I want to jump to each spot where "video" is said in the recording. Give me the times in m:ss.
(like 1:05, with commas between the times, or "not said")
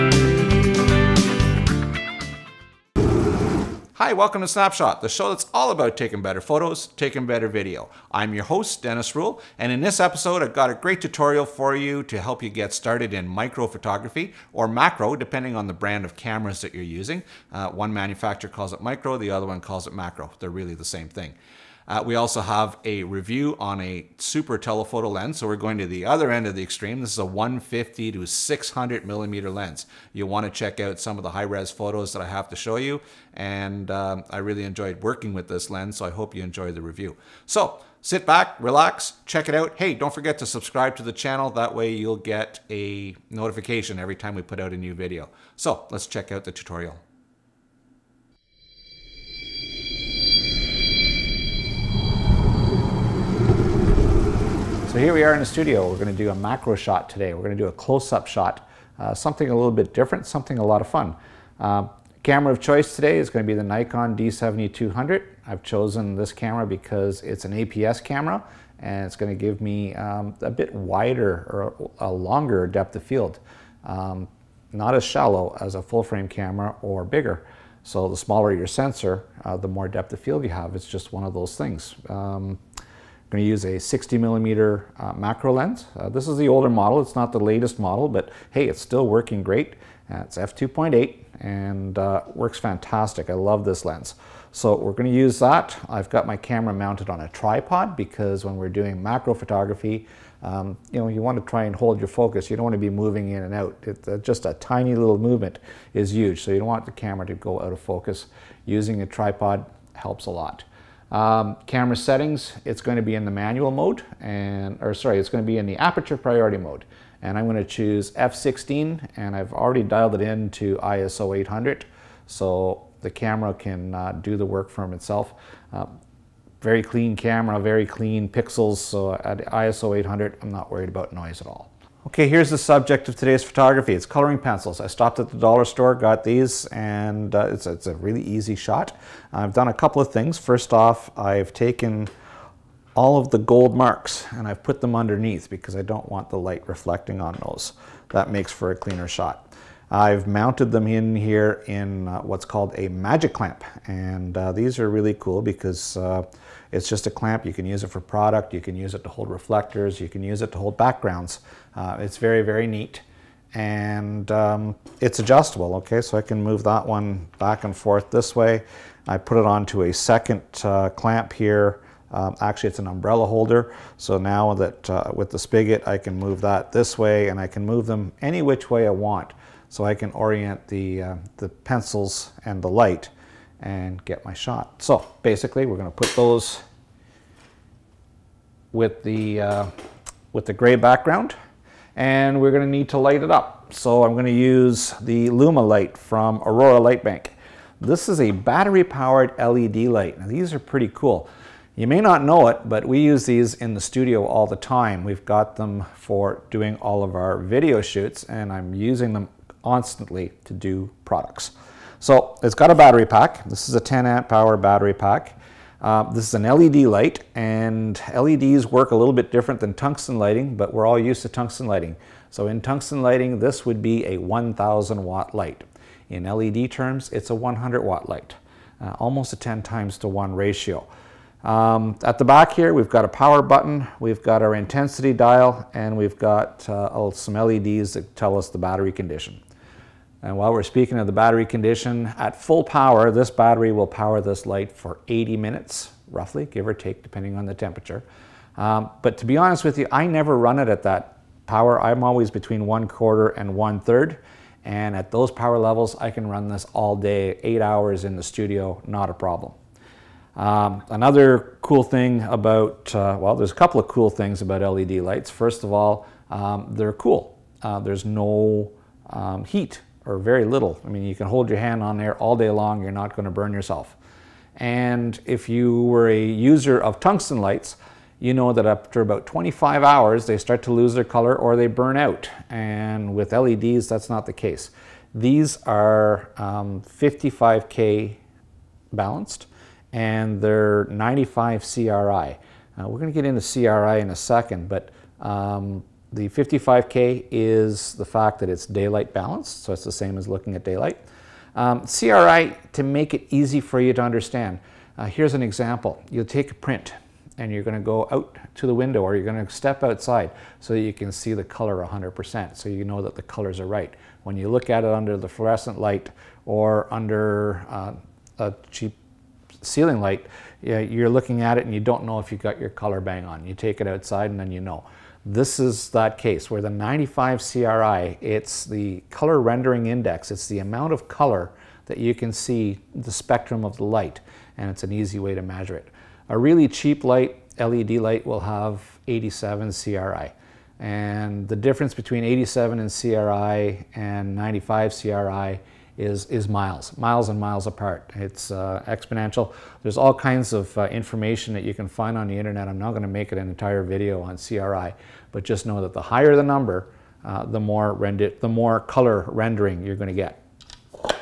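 0:07, 0:44, 3:27, 5:53.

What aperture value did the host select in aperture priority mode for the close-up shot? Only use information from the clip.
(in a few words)
f16.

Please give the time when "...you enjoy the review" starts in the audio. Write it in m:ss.
0:36.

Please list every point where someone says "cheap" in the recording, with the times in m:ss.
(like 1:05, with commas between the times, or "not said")
5:18, 5:36.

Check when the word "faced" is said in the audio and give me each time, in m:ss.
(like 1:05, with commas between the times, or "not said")
not said.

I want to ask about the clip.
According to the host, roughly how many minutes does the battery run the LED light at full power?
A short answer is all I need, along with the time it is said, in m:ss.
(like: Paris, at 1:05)
80 minutes, at 4:05.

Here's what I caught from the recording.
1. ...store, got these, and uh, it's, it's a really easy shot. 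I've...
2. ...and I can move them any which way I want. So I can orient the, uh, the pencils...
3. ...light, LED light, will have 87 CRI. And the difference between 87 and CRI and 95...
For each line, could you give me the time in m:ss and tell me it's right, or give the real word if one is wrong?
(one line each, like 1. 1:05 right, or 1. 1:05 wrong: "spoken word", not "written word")
1. 2:15 right
2. 2:57 right
3. 5:37 right.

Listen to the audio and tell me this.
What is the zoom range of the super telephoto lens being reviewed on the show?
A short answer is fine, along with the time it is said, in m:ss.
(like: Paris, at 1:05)
150 to 600 millimeter, at 0:27.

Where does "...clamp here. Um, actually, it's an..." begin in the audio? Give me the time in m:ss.
2:50.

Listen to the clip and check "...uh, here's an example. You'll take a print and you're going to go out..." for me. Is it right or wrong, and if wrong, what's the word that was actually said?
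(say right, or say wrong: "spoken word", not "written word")
right.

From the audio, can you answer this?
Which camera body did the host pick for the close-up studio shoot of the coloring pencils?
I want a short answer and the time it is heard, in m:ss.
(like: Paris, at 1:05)
Nikon D7200, at 1:03.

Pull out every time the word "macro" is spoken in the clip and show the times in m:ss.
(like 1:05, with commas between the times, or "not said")
0:14, 0:19, 0:56, 1:25, 1:39.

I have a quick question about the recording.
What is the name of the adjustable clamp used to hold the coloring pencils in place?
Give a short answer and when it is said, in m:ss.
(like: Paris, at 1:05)
magic clamp, at 2:32.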